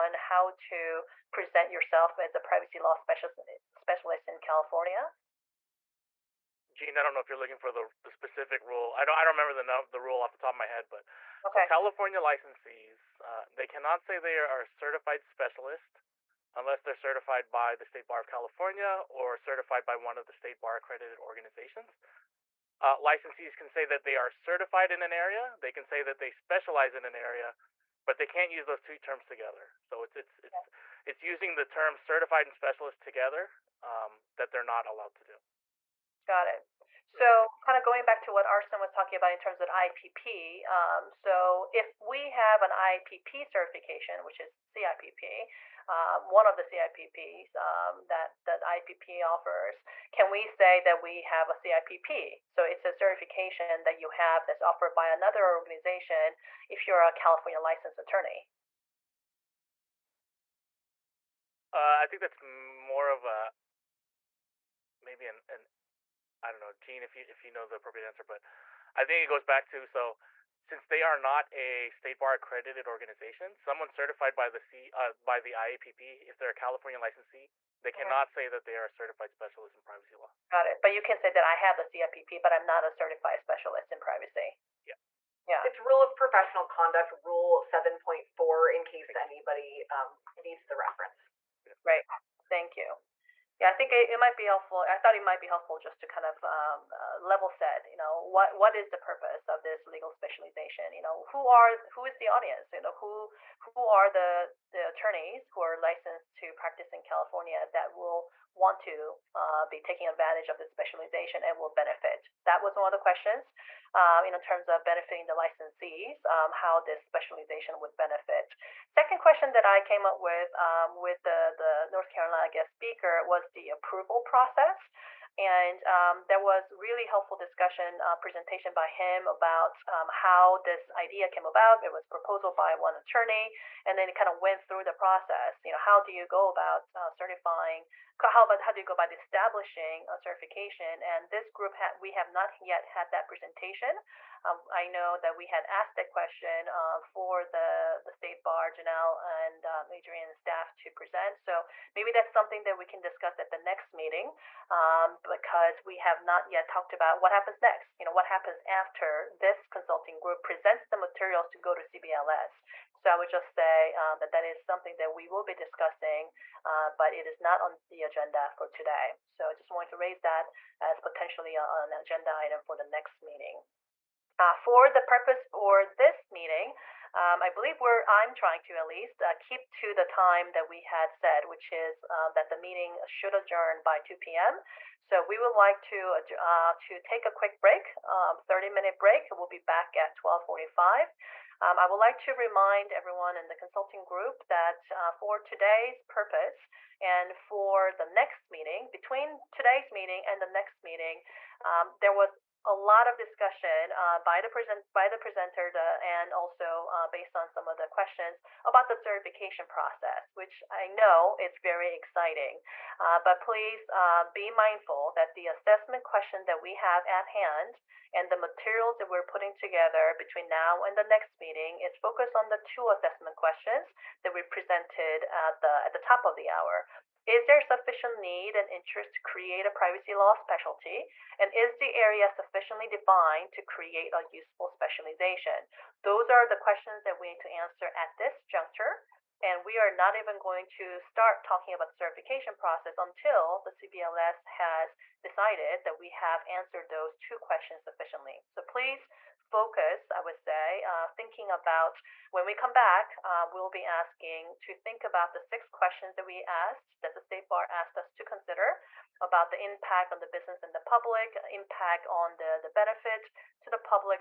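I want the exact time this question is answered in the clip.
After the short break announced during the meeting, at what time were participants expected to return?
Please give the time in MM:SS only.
03:10.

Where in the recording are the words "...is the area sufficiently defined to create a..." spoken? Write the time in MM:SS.
03:51.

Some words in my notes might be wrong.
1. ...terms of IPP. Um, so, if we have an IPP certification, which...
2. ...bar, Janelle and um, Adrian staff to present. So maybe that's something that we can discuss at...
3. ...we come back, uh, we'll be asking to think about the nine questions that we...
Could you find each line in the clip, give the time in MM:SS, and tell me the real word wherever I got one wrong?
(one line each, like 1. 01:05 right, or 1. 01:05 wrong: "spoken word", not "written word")
1. 00:39 right
2. 02:28 right
3. 04:12 wrong: "six", not "nine".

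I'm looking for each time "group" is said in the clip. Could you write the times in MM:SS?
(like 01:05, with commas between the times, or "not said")
02:21, 02:40, 03:14.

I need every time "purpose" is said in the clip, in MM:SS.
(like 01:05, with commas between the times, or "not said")
01:38, 02:55, 03:16.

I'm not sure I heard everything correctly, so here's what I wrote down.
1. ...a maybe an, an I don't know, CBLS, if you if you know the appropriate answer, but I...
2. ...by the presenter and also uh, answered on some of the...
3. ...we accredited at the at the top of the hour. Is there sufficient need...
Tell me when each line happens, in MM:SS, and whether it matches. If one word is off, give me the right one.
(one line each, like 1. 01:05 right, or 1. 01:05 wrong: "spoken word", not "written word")
1. 01:03 wrong: "Gene", not "CBLS"
2. 03:24 wrong: "based", not "answered"
3. 03:44 wrong: "presented", not "accredited".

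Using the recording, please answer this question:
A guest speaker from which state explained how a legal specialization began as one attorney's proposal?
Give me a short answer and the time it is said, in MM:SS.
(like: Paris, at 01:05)
North Carolina, at 02:01.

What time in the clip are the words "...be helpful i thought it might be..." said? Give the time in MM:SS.
01:34.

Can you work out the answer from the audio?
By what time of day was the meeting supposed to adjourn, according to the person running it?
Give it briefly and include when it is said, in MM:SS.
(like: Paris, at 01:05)
2 p.m., at 03:03.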